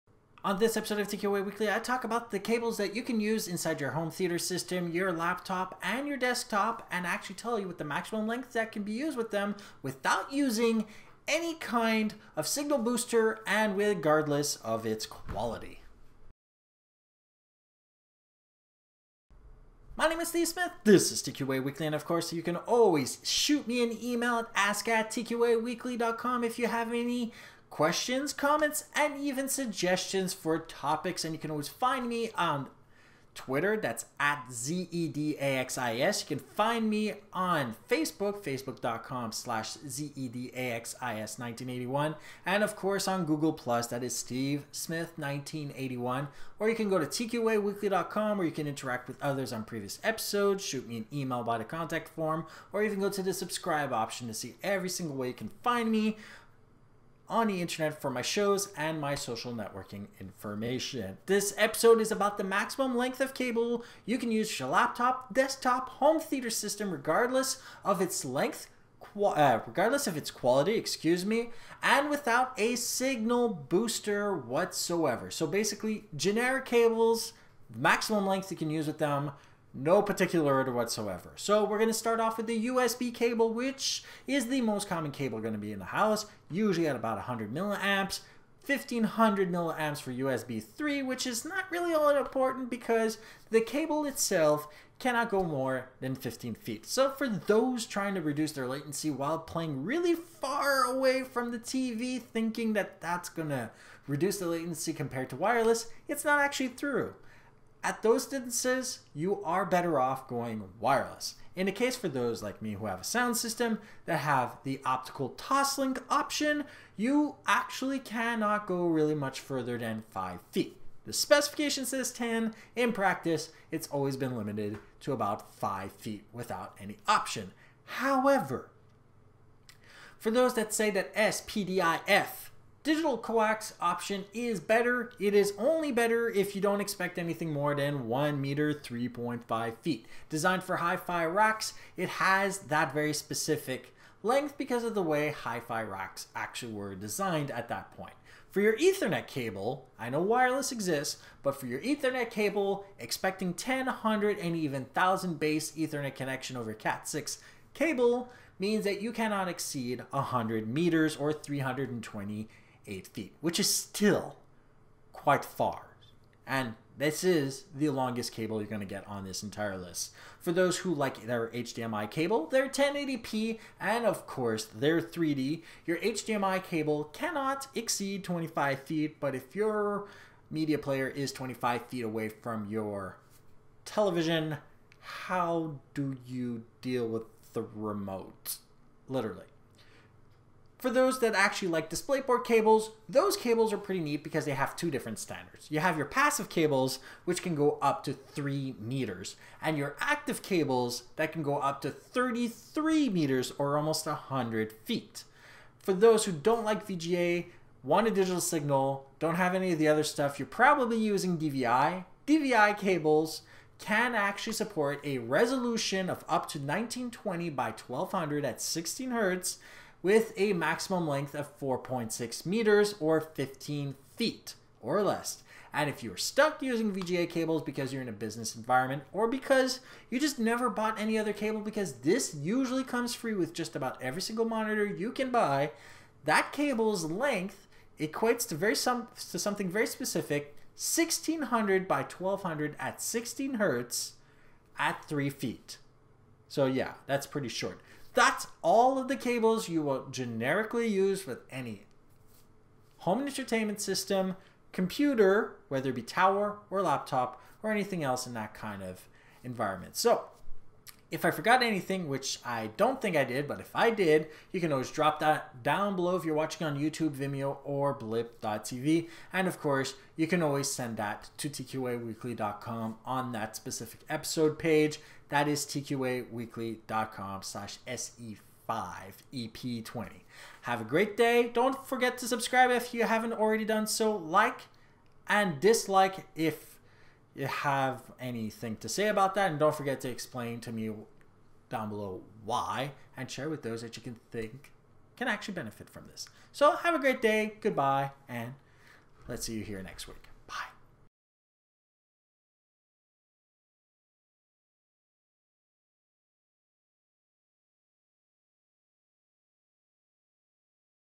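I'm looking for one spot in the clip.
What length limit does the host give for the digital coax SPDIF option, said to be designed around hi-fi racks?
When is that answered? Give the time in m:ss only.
2:18.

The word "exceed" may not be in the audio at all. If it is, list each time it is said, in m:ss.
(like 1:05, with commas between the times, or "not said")
2:39, 2:57.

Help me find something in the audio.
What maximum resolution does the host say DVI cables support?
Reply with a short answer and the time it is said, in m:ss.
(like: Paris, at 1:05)
1920 by 1200, at 3:36.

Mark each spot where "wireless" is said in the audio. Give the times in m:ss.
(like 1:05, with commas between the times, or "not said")
1:45, 1:50, 2:30.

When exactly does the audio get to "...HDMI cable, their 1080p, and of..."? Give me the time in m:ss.
2:51.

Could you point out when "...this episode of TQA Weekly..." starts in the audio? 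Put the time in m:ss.
0:00.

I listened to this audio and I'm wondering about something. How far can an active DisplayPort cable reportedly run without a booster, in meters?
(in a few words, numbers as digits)
33 meters.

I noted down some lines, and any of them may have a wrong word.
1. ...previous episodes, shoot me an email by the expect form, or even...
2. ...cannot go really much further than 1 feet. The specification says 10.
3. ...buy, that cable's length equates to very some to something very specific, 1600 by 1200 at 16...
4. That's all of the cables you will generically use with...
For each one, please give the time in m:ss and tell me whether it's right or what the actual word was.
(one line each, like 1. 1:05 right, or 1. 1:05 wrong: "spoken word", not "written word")
1. 0:49 wrong: "contact", not "expect"
2. 1:57 wrong: "5", not "1"
3. 3:55 right
4. 4:08 right.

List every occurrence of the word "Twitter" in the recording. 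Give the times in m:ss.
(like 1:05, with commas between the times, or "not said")
0:33.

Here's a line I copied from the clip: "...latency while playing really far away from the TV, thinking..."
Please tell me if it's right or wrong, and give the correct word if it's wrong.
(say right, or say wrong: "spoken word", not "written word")
right.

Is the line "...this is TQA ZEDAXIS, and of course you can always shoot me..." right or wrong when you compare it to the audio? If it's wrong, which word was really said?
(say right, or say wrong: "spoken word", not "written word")
wrong: "Weekly", not "ZEDAXIS".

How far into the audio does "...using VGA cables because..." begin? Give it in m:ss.
3:46.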